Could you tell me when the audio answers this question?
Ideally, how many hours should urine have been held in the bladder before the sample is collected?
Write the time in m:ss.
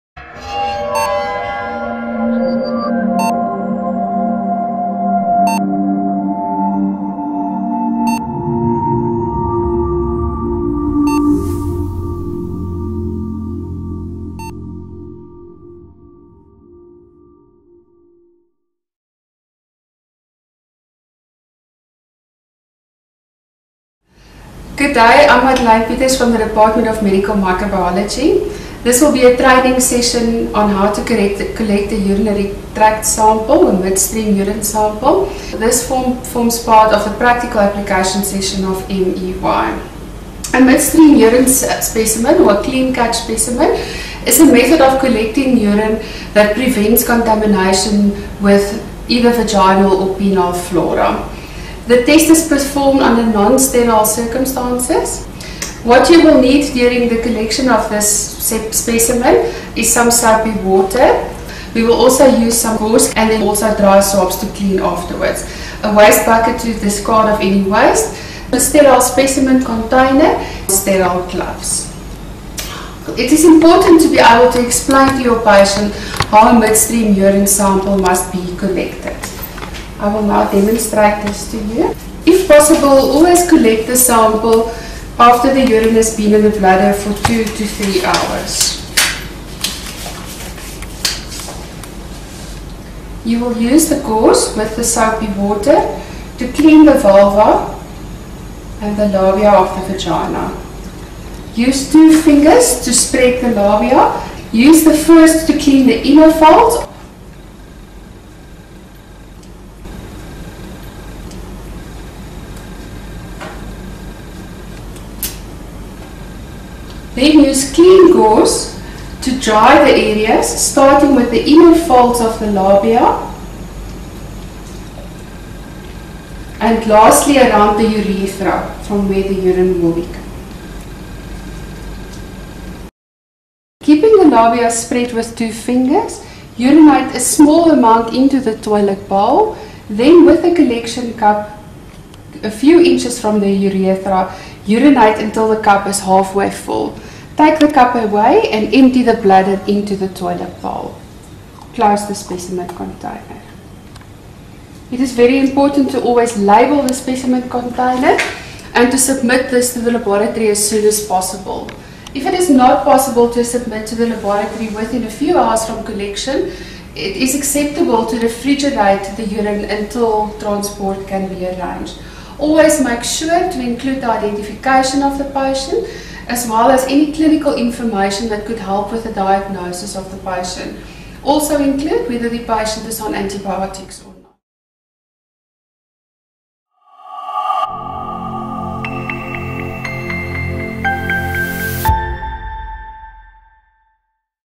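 1:27.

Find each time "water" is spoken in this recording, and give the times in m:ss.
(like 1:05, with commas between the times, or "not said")
1:00, 1:35.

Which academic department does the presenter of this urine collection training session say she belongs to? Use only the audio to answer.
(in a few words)
Department of Medical Microbiology.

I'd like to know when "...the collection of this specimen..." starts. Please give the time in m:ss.
0:57.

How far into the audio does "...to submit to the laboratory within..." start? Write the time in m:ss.
2:43.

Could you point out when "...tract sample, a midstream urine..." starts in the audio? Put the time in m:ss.
0:32.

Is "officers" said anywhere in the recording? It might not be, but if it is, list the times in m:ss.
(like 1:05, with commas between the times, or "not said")
not said.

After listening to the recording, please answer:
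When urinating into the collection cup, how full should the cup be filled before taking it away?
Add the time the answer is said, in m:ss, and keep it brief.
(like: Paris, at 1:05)
Halfway full, at 2:26.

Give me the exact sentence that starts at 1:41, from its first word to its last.
Use two fingers to spread the labia.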